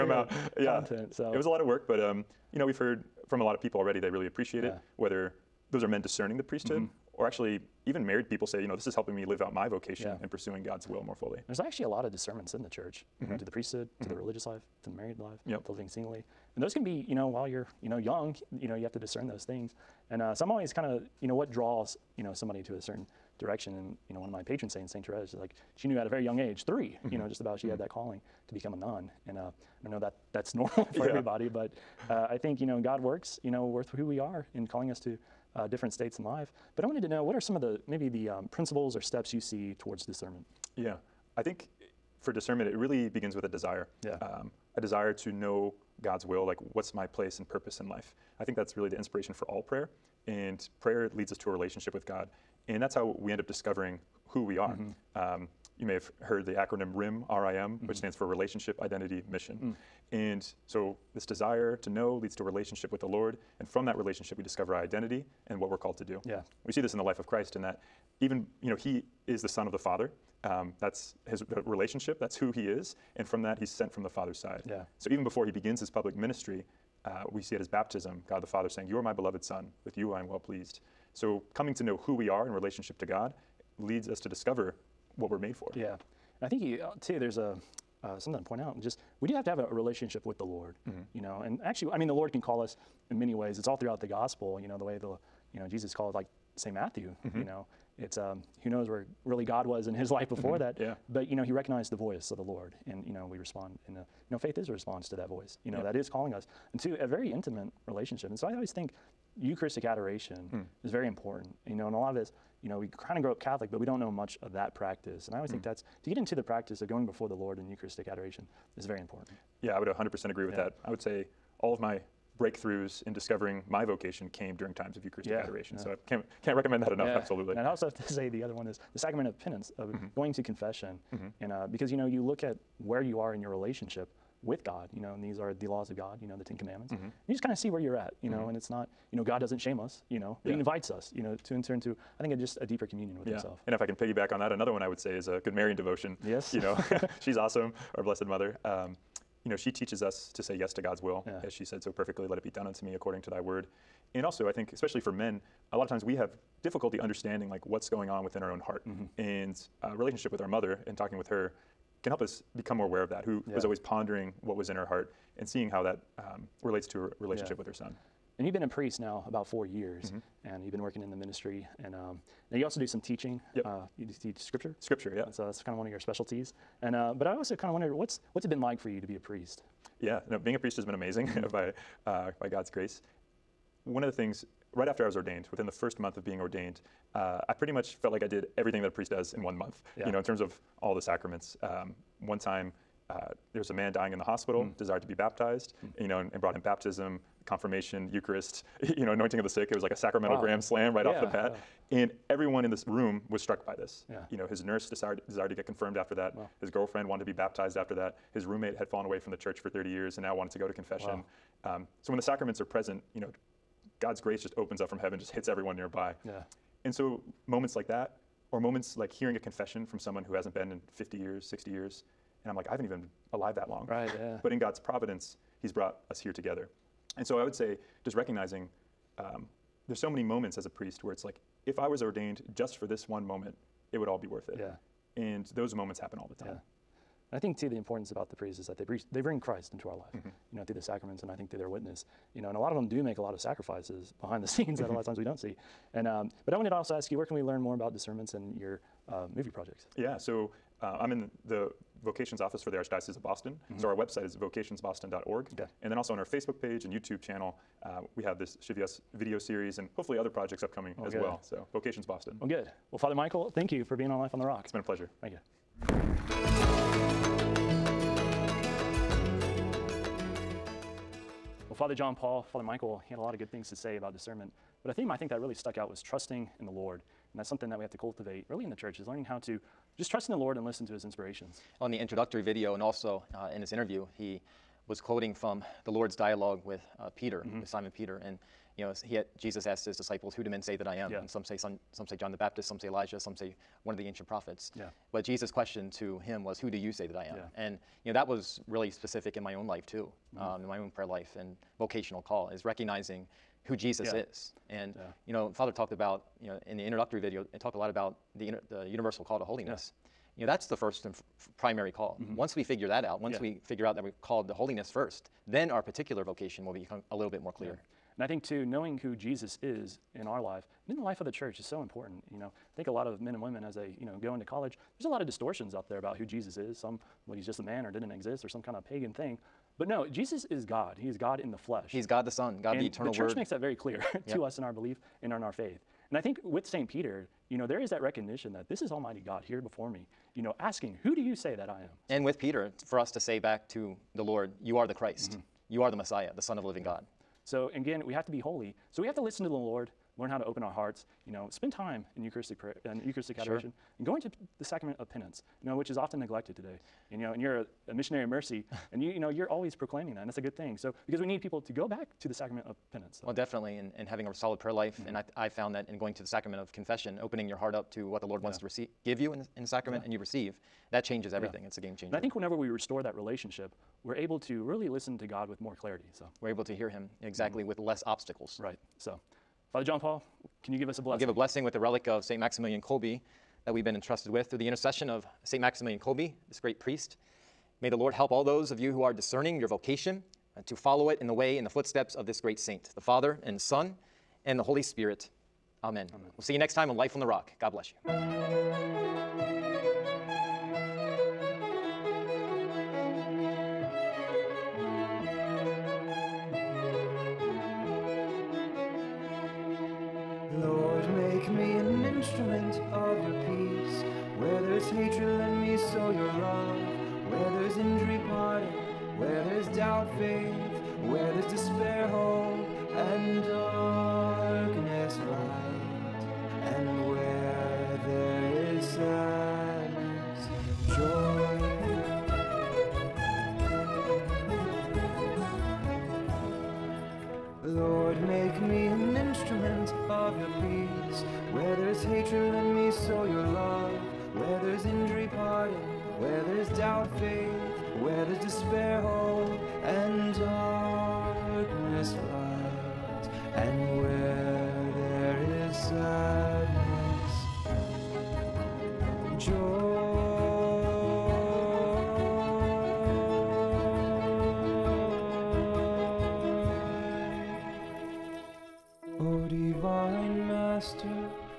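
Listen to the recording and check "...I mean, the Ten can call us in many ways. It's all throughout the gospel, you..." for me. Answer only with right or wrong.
wrong.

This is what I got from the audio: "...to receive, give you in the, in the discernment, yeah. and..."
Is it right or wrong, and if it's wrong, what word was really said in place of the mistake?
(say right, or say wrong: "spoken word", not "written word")
wrong: "sacrament", not "discernment".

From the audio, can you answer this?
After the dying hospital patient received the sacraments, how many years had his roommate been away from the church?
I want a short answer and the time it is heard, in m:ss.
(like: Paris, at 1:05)
30, at 3:29.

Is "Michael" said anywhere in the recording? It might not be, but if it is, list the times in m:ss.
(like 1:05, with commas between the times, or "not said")
4:23, 4:32.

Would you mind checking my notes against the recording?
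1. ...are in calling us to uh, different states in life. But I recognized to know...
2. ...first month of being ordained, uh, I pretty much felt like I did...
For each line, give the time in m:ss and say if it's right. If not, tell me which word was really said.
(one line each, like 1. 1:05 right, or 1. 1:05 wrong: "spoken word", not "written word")
1. 0:34 wrong: "wanted", not "recognized"
2. 3:05 right.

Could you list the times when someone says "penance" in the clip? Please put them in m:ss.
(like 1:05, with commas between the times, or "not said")
2:09, 5:55, 6:02.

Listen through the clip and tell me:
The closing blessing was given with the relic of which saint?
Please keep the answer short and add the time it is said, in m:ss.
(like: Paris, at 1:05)
Saint Maximilian Kolbe, at 6:22.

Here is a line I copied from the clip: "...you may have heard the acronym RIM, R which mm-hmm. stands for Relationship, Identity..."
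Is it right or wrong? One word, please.
right.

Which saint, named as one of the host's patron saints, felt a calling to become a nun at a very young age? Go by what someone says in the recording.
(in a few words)
St. Therese.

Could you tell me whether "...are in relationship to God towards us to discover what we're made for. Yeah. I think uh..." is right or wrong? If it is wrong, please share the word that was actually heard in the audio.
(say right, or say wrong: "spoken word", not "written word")
wrong: "leads", not "towards".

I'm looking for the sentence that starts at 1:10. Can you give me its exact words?
Um, that's his relationship, that's who he is.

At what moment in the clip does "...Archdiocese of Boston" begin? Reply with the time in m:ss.
4:12.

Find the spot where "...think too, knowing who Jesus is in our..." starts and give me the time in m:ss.
5:18.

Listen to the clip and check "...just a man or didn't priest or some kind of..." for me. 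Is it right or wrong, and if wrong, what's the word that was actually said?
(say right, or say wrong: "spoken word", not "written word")
wrong: "exist", not "priest".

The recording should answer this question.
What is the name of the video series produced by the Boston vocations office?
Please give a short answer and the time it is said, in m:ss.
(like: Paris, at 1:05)
Scivias, at 4:18.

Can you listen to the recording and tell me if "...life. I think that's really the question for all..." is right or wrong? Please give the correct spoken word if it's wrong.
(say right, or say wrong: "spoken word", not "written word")
wrong: "inspiration", not "question".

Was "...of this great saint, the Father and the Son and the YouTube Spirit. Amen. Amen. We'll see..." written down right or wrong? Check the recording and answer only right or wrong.
wrong.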